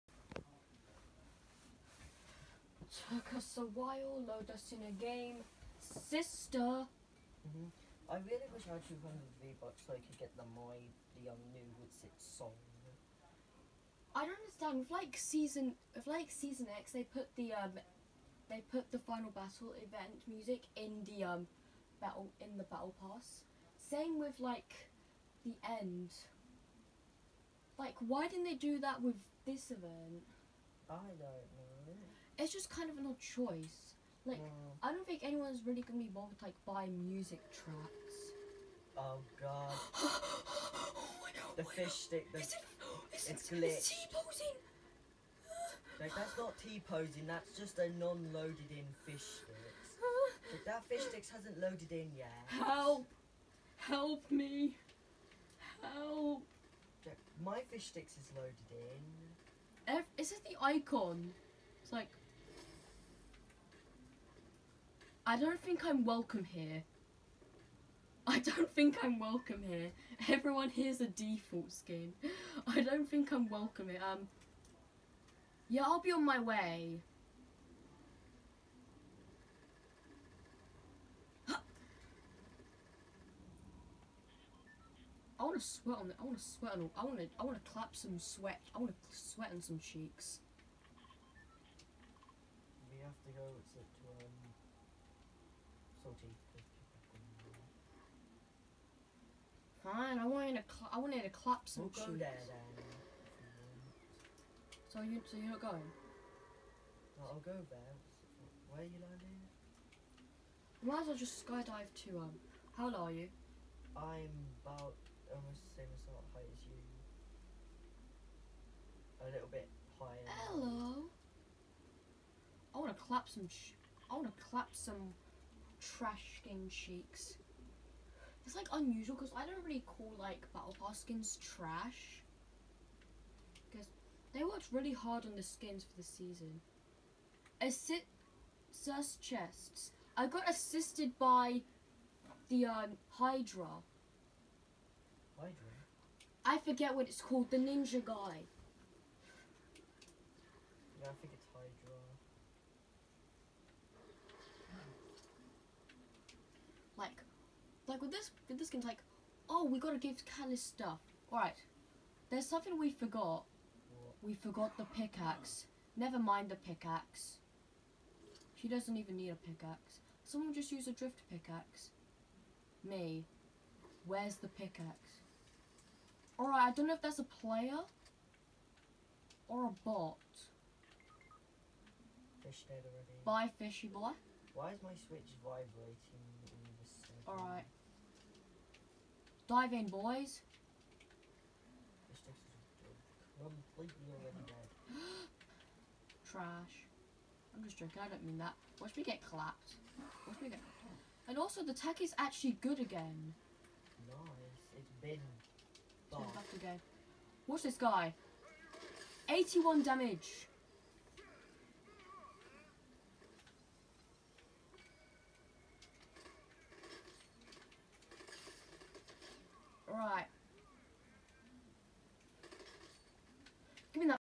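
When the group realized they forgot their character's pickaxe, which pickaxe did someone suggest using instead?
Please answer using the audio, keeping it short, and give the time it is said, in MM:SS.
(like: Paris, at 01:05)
drift pickaxe, at 02:50.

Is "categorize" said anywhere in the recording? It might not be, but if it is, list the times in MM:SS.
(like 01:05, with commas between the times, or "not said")
not said.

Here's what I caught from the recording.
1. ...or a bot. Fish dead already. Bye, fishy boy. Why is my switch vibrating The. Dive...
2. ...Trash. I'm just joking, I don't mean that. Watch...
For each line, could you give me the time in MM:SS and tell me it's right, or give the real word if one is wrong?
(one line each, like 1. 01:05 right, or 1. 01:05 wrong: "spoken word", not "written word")
1. 02:59 wrong: "Alright", not "The"
2. 03:16 right.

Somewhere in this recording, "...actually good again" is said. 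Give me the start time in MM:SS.
03:22.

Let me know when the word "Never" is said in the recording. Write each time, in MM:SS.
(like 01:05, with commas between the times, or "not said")
02:45.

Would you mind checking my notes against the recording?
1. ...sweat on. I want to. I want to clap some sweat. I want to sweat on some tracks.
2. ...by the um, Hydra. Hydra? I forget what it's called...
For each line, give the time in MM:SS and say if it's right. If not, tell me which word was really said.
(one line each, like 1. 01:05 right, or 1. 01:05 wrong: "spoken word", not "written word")
1. 01:26 wrong: "cheeks", not "tracks"
2. 02:21 right.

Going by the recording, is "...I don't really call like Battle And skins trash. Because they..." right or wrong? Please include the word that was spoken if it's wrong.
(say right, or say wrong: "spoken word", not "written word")
wrong: "Pass", not "And".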